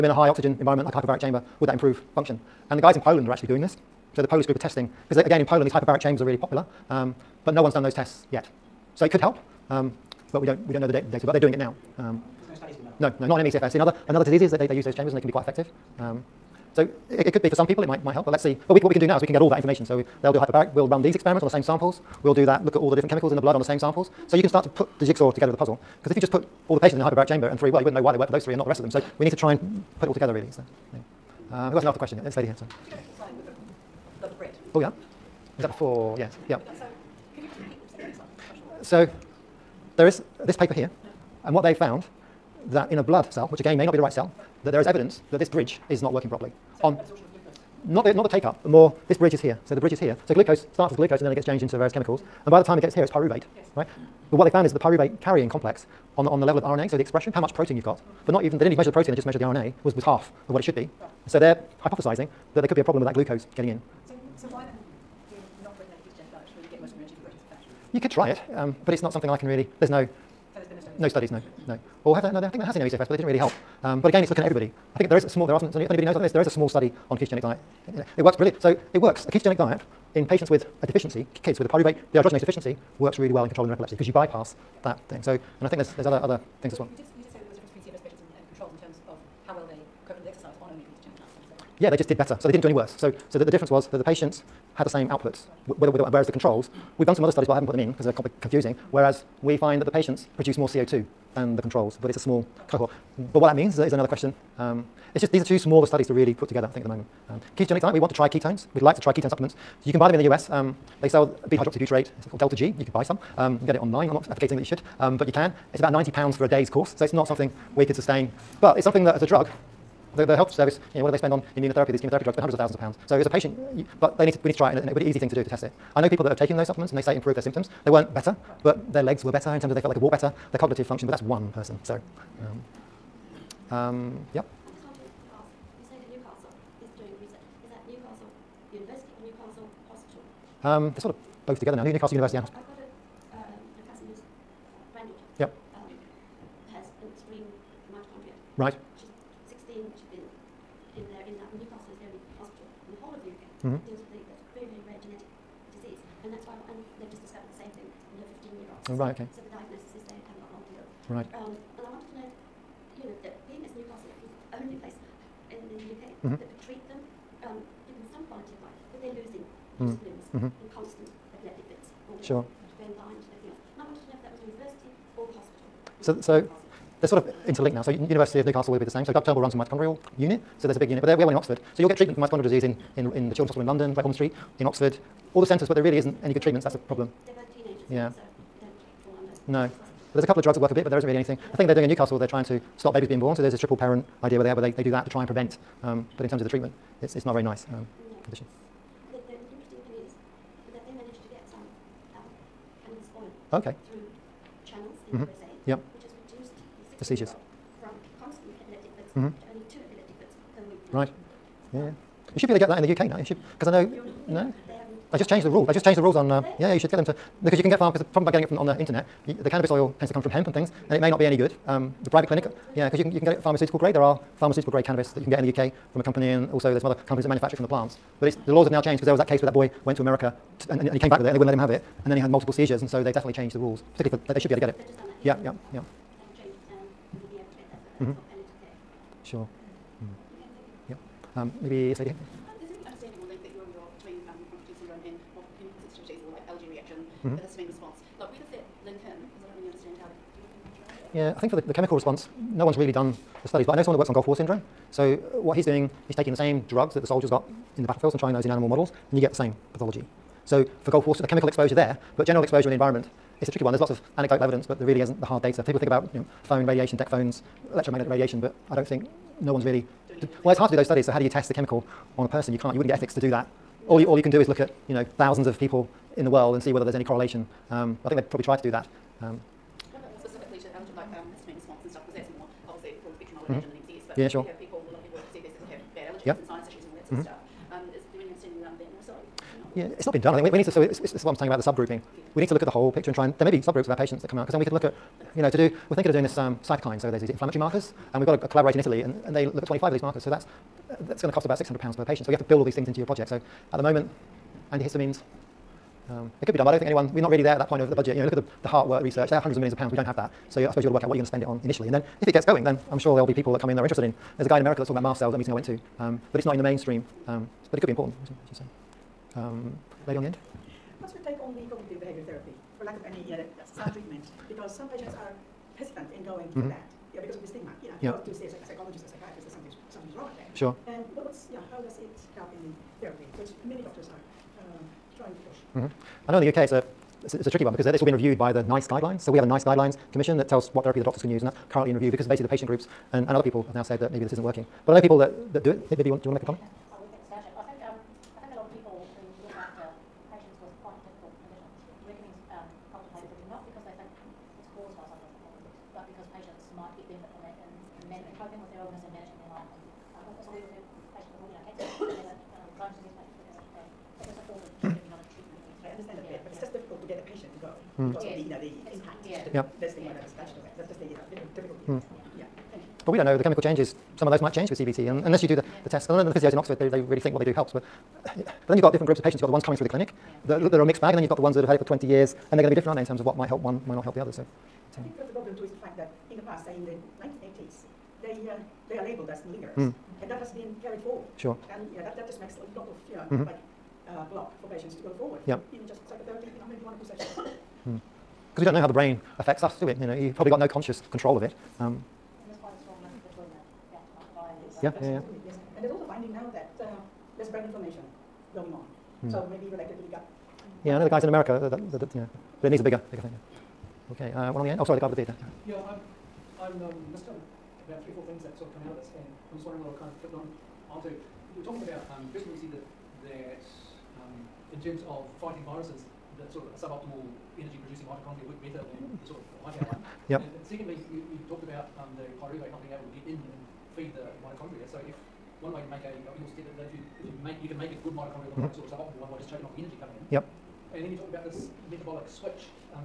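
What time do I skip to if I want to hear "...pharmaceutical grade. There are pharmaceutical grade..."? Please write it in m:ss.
3:43.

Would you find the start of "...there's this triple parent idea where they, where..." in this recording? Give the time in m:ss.
3:13.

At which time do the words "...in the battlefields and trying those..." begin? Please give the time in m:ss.
4:17.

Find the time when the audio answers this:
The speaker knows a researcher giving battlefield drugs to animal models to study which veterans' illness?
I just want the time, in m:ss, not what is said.
4:14.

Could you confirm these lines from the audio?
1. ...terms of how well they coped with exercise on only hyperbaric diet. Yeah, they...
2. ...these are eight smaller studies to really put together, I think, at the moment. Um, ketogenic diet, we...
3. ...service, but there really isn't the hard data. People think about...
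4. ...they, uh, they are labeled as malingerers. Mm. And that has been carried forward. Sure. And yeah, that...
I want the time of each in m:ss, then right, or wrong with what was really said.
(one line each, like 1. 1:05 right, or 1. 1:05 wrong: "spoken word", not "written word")
1. 1:28 wrong: "ketogenic", not "hyperbaric"
2. 1:45 wrong: "two", not "eight"
3. 4:24 wrong: "evidence", not "service"
4. 6:28 right.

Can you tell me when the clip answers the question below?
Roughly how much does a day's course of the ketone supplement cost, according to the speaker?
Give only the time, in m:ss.
1:55.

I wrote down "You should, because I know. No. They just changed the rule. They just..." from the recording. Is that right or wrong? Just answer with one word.
right.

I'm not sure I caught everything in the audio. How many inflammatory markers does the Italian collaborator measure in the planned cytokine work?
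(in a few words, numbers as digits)
25.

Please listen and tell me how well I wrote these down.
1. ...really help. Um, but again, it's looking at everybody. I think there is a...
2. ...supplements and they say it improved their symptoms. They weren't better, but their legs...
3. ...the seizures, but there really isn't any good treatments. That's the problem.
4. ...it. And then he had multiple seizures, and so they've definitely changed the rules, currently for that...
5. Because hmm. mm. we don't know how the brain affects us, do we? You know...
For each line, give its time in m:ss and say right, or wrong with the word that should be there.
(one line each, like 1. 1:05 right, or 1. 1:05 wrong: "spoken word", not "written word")
1. 1:13 right
2. 2:06 right
3. 3:05 wrong: "centres", not "seizures"
4. 3:51 wrong: "particularly", not "currently"
5. 6:37 right.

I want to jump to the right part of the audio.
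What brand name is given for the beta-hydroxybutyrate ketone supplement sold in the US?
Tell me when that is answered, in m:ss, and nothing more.
1:52.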